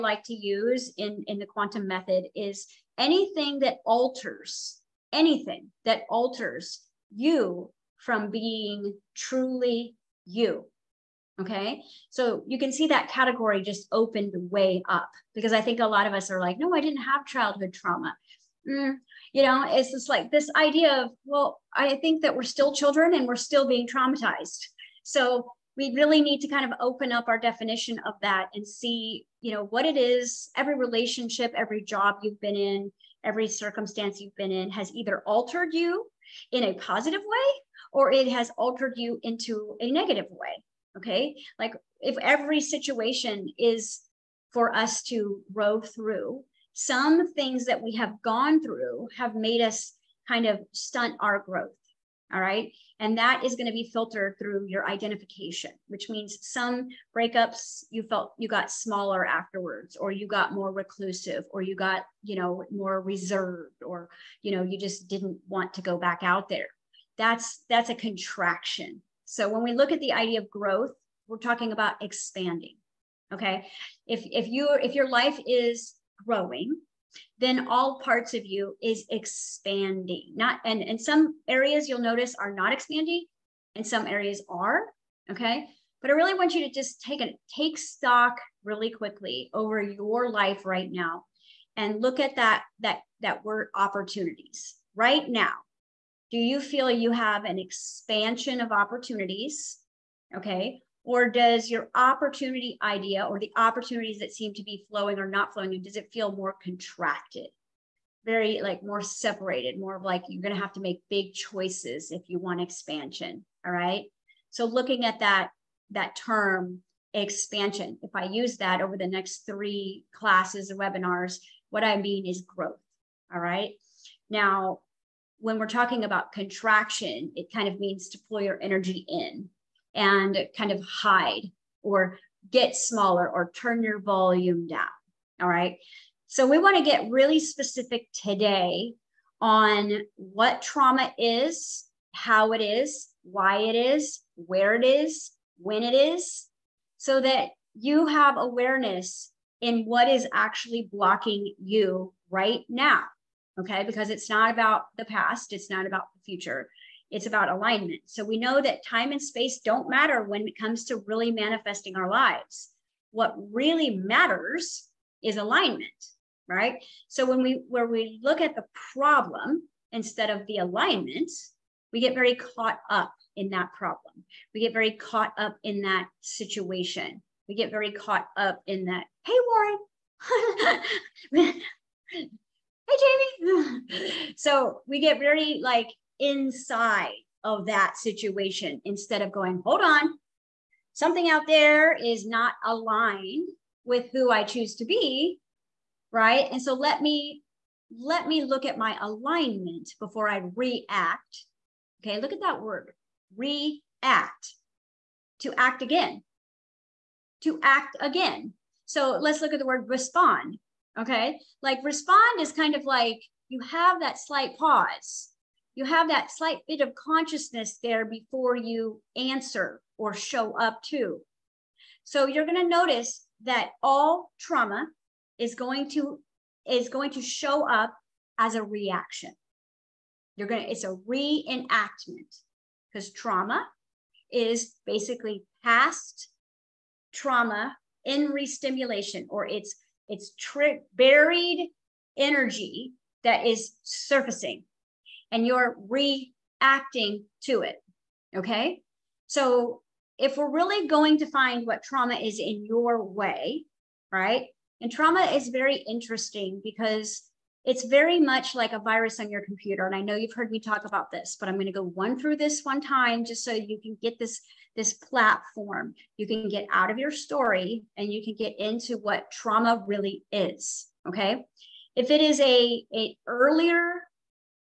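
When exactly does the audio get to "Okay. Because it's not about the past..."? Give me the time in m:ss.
2:33.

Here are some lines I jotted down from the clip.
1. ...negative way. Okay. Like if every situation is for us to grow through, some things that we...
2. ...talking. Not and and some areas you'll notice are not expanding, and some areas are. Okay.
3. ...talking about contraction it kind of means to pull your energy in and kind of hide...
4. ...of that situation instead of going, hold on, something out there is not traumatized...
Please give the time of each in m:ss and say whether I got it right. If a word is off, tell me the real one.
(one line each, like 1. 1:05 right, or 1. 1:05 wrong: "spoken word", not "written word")
1. 0:39 right
2. 1:19 wrong: "expanding", not "talking"
3. 2:05 right
4. 3:07 wrong: "aligned", not "traumatized".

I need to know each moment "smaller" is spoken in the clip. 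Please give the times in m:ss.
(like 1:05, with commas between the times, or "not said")
0:58, 2:12.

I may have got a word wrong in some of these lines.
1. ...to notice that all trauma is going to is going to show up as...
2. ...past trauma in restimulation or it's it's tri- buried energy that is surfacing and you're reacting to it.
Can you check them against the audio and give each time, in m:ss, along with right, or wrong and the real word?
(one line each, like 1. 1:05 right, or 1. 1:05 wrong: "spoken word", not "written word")
1. 3:42 right
2. 3:55 right.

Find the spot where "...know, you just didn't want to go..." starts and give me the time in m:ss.
1:04.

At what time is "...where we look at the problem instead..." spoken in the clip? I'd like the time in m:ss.
2:47.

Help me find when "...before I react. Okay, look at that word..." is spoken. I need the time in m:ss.
3:19.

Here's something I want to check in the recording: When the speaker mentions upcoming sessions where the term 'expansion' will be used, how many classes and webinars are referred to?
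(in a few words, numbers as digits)
3.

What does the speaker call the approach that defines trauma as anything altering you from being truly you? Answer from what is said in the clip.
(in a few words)
the quantum method.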